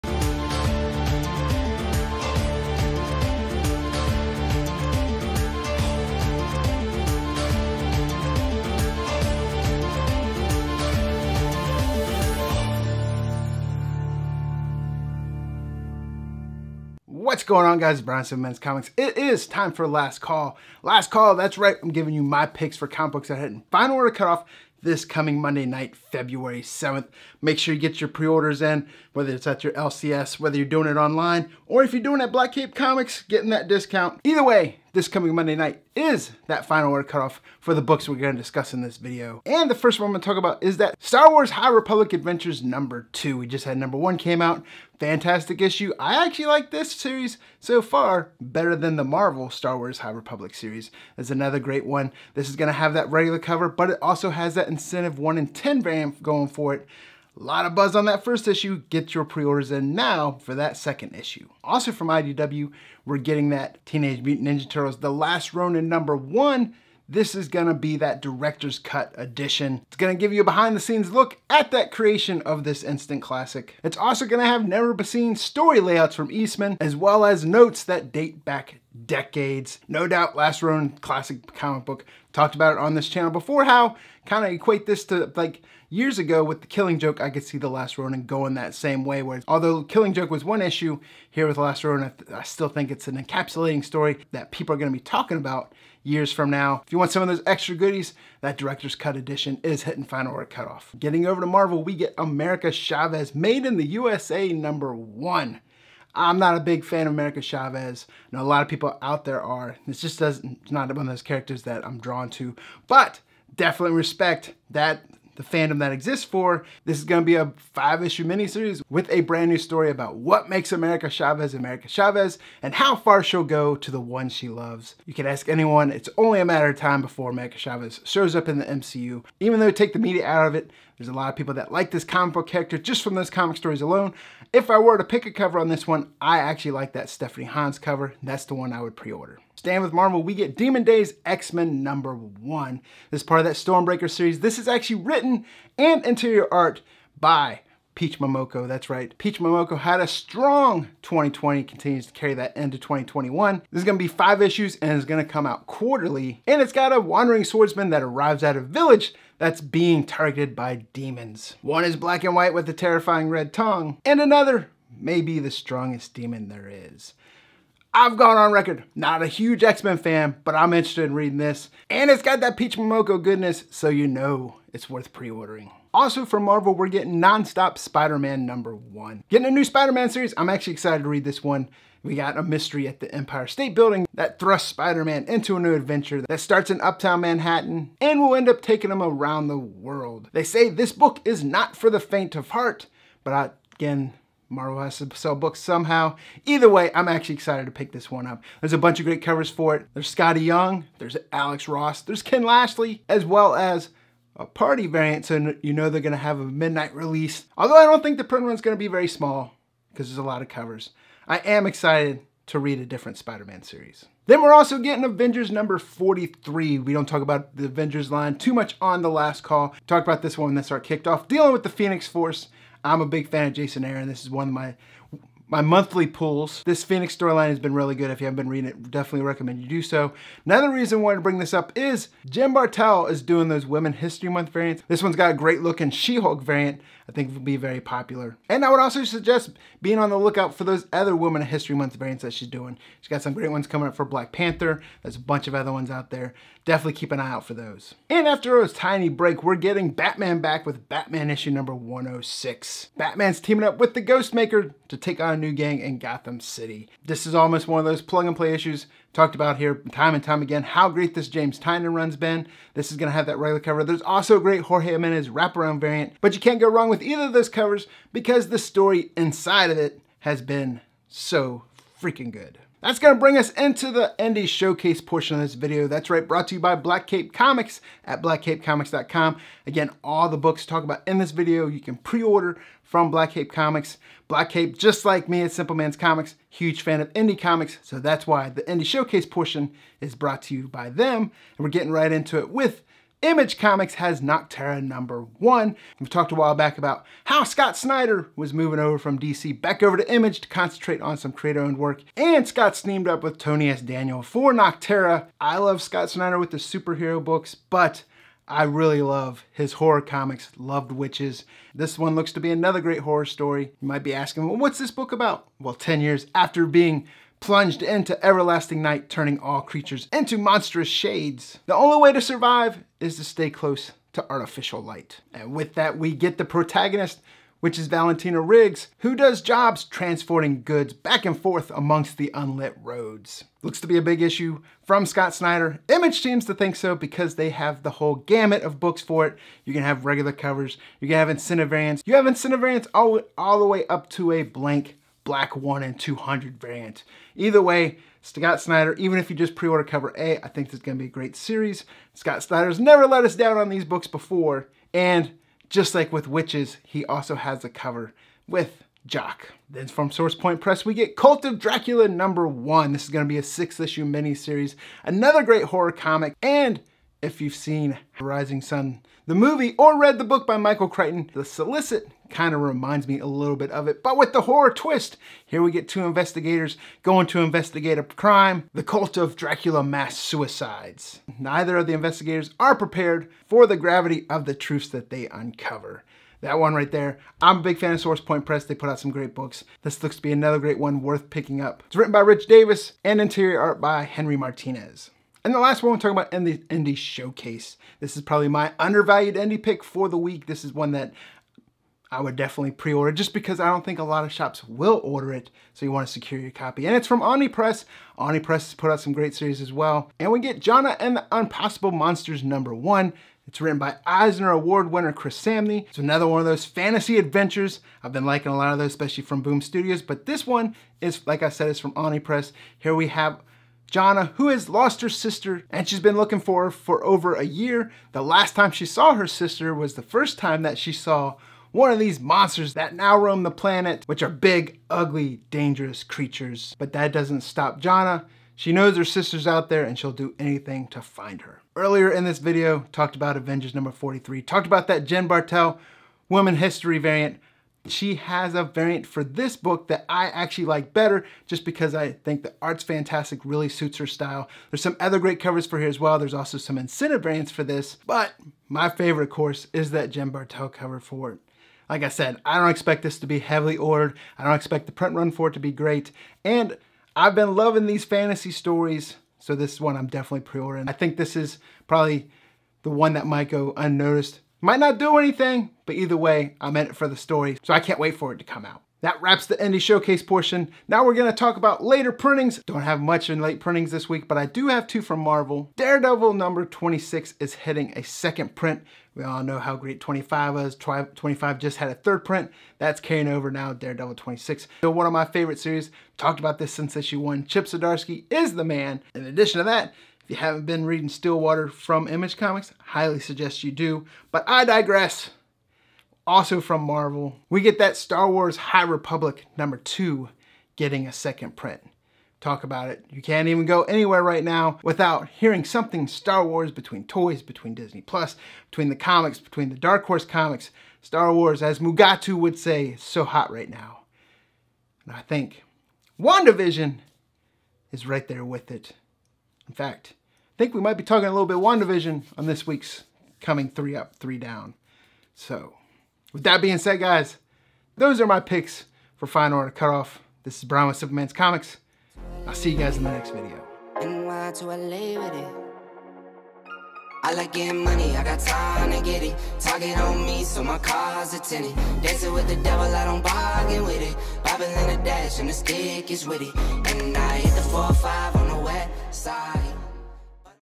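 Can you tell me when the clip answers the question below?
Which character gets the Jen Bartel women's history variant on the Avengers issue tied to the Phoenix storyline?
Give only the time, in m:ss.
3:55.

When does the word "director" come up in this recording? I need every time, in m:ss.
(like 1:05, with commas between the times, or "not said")
1:08, 1:38.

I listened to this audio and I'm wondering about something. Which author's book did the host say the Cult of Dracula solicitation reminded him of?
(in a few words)
Michael Crichton.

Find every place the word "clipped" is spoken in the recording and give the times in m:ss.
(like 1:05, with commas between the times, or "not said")
not said.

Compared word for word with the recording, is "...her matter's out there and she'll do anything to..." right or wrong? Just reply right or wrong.
wrong.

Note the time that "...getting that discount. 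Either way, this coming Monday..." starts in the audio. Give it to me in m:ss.
0:33.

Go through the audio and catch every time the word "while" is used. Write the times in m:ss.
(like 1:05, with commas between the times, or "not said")
4:56.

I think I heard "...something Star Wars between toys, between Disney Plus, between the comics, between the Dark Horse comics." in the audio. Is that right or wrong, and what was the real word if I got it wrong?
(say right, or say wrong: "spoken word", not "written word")
right.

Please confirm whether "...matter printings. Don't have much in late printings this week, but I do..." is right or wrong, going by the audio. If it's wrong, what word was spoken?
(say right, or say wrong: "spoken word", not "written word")
wrong: "later", not "matter".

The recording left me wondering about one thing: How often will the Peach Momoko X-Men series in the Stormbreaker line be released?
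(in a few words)
Quarterly.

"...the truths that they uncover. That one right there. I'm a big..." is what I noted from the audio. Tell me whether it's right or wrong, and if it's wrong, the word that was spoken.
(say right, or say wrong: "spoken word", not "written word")
right.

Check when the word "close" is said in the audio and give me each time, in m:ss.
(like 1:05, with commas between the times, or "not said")
5:23.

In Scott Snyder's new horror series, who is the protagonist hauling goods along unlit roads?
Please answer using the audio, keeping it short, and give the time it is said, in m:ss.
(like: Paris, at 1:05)
Valentina Riggs, at 5:27.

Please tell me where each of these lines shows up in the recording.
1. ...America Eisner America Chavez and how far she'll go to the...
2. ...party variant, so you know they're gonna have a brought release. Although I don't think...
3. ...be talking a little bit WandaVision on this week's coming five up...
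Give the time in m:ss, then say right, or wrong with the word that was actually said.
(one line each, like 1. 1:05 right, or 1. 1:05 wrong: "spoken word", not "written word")
1. 2:00 wrong: "Chavez", not "Eisner"
2. 3:24 wrong: "midnight", not "brought"
3. 8:50 wrong: "three", not "five".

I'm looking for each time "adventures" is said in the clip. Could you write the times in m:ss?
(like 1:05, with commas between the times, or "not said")
0:42, 3:05, 6:57.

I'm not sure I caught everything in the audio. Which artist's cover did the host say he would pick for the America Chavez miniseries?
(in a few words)
Stephanie Hans.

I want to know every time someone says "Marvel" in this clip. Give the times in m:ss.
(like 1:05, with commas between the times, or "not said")
0:49, 1:41, 2:19, 2:56, 3:14, 8:05, 8:26.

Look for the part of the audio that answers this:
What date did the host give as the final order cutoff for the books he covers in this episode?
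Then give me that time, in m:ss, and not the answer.
0:25.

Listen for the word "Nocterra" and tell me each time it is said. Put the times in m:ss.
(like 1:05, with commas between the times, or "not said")
4:54, 5:04.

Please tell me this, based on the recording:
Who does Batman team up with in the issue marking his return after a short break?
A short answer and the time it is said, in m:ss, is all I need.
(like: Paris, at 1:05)
Ghostmaker, at 4:14.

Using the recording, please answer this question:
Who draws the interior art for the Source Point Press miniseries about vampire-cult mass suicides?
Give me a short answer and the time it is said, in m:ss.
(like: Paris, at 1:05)
Henry Martinez, at 6:34.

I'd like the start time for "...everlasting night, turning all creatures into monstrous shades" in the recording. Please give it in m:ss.
5:18.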